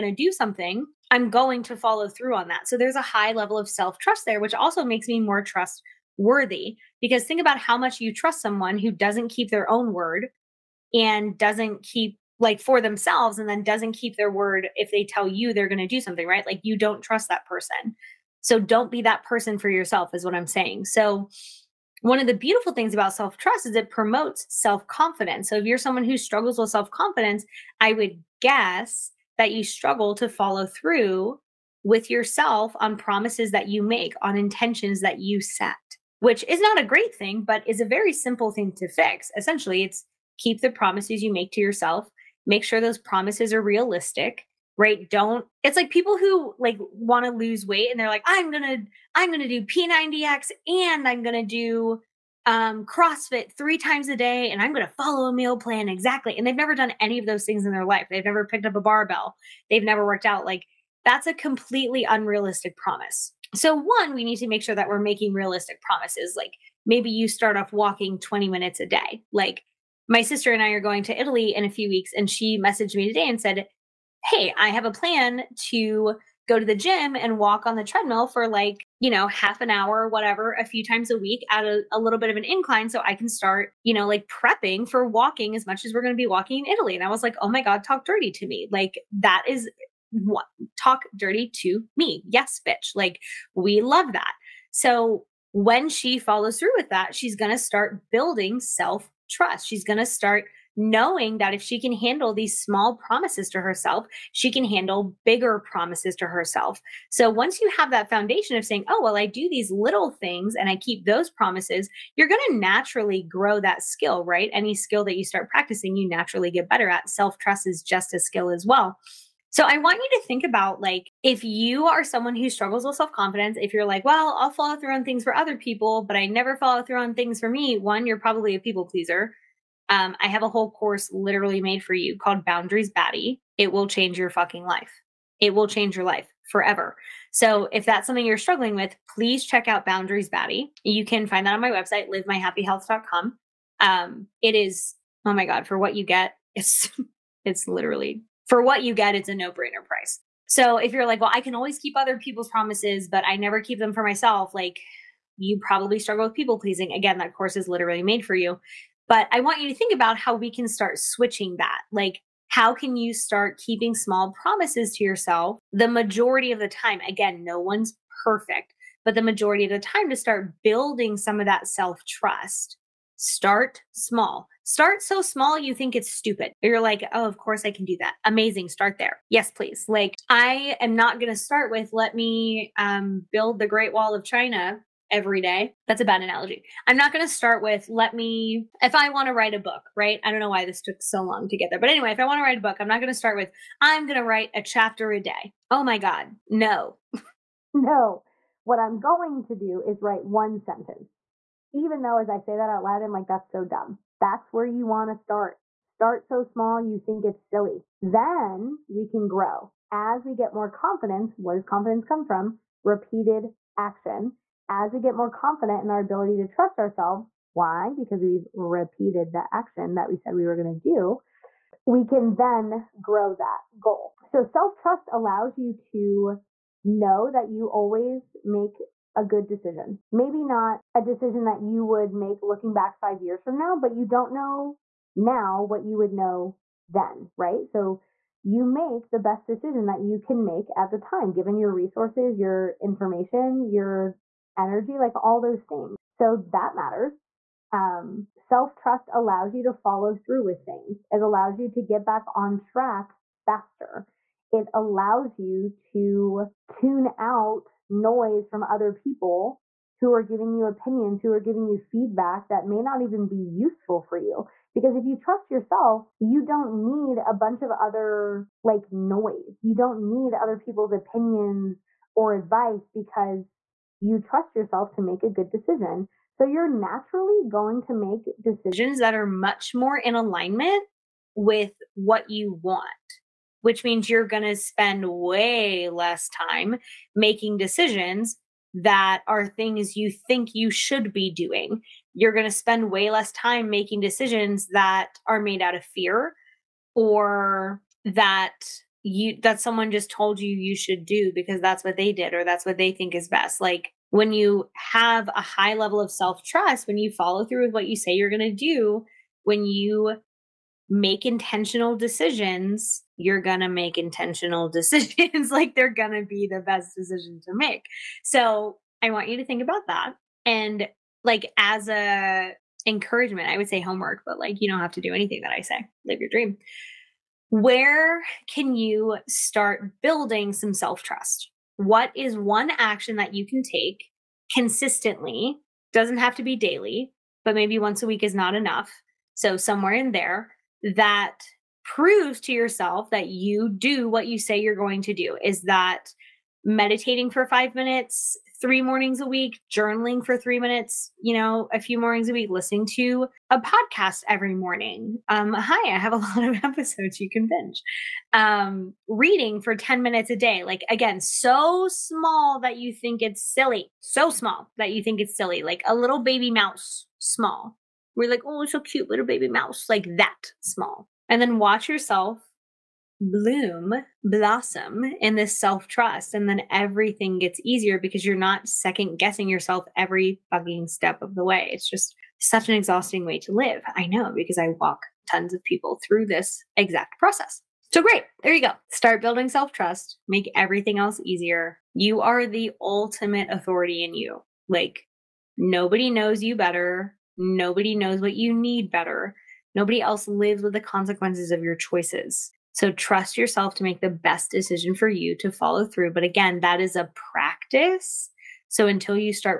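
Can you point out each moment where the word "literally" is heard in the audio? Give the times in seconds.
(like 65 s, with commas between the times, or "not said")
131 s, 147 s, 157 s.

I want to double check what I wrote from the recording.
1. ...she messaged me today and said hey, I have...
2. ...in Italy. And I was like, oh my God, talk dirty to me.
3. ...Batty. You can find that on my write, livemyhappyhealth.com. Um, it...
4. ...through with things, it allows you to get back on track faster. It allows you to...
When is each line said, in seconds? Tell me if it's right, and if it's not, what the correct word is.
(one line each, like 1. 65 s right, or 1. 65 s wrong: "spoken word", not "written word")
1. 72 s right
2. 86 s right
3. 140 s wrong: "website", not "write"
4. 250 s right.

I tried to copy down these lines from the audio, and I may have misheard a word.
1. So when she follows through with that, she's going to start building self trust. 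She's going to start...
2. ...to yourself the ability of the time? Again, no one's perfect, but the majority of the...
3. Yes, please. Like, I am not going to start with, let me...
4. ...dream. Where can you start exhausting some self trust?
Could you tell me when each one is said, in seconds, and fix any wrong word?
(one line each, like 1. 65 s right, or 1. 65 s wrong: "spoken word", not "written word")
1. 94 s right
2. 164 s wrong: "majority", not "ability"
3. 179 s right
4. 326 s wrong: "building", not "exhausting".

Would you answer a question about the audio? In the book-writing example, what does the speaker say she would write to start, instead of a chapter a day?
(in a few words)
One sentence.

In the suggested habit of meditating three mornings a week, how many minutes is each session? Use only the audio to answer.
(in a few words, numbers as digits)
5 minutes.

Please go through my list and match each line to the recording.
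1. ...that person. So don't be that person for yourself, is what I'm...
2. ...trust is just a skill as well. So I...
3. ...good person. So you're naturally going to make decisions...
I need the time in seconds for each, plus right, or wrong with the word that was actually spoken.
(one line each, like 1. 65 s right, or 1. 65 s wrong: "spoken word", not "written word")
1. 17 s right
2. 117 s right
3. 275 s wrong: "decision", not "person".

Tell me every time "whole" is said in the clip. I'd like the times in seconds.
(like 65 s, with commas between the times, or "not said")
130 s.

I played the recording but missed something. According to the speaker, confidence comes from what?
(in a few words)
Repeated action.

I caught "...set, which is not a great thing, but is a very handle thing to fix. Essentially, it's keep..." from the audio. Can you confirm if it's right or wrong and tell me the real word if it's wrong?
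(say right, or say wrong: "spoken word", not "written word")
wrong: "simple", not "handle".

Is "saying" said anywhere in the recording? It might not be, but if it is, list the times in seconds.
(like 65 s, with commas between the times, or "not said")
20 s, 108 s.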